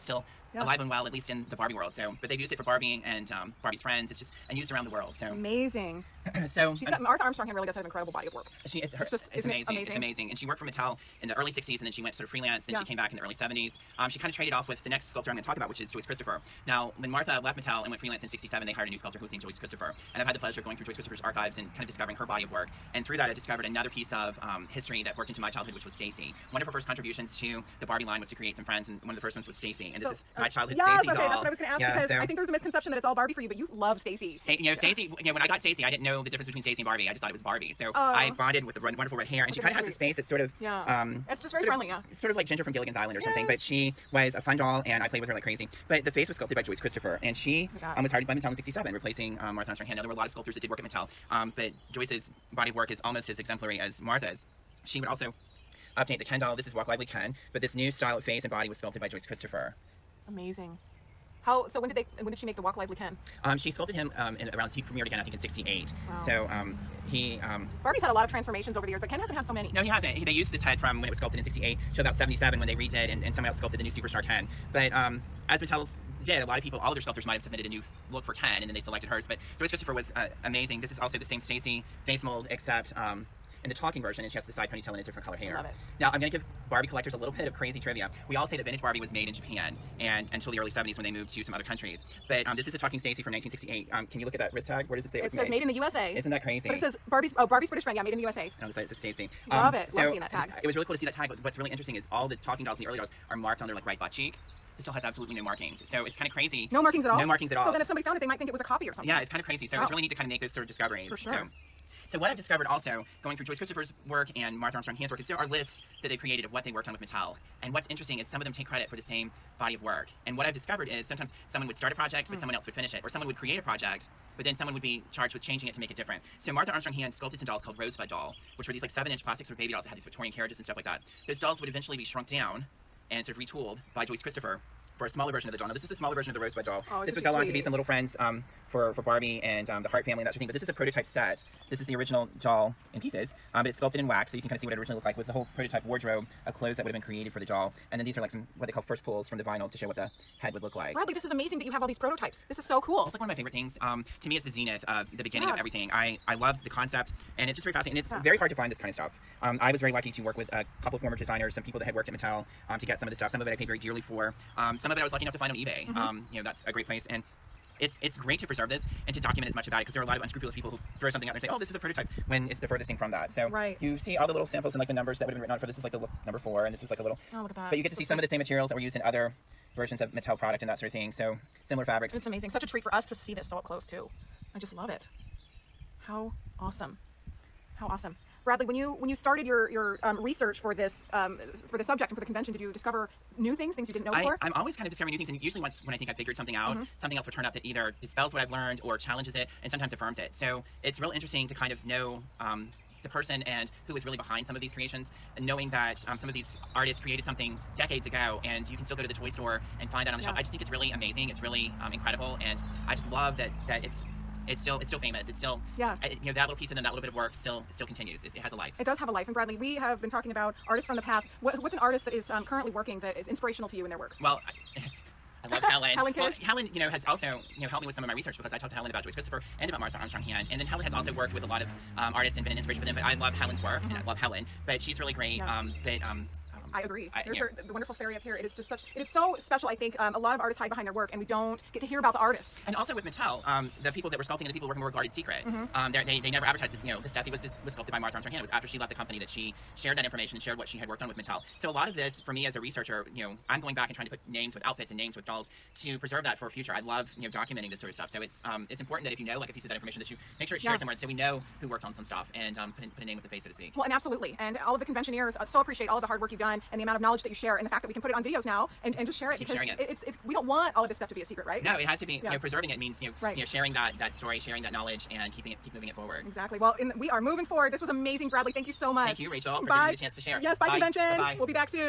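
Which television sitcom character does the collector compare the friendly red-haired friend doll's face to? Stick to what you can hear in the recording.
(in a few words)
Ginger.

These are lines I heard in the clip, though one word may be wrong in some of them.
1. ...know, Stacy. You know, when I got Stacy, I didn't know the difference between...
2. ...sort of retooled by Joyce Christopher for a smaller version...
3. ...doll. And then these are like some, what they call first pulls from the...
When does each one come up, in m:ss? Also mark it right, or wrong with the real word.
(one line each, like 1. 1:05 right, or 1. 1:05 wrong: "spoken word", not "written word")
1. 0:34 right
2. 2:13 right
3. 2:27 right.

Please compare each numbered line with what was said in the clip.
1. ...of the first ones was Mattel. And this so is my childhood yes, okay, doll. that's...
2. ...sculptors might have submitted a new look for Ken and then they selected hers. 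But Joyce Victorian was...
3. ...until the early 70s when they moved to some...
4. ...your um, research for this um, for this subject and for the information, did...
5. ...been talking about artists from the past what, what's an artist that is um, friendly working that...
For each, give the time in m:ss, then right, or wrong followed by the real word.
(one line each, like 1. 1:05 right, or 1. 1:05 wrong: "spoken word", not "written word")
1. 0:29 wrong: "Stacy", not "Mattel"
2. 1:17 wrong: "Christopher", not "Victorian"
3. 1:30 right
4. 3:09 wrong: "convention", not "information"
5. 3:40 wrong: "currently", not "friendly".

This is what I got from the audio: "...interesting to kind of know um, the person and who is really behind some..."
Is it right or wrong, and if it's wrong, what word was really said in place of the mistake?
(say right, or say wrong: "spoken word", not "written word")
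right.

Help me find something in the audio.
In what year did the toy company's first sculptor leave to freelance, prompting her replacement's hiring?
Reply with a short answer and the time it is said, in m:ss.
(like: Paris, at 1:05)
1967, at 0:18.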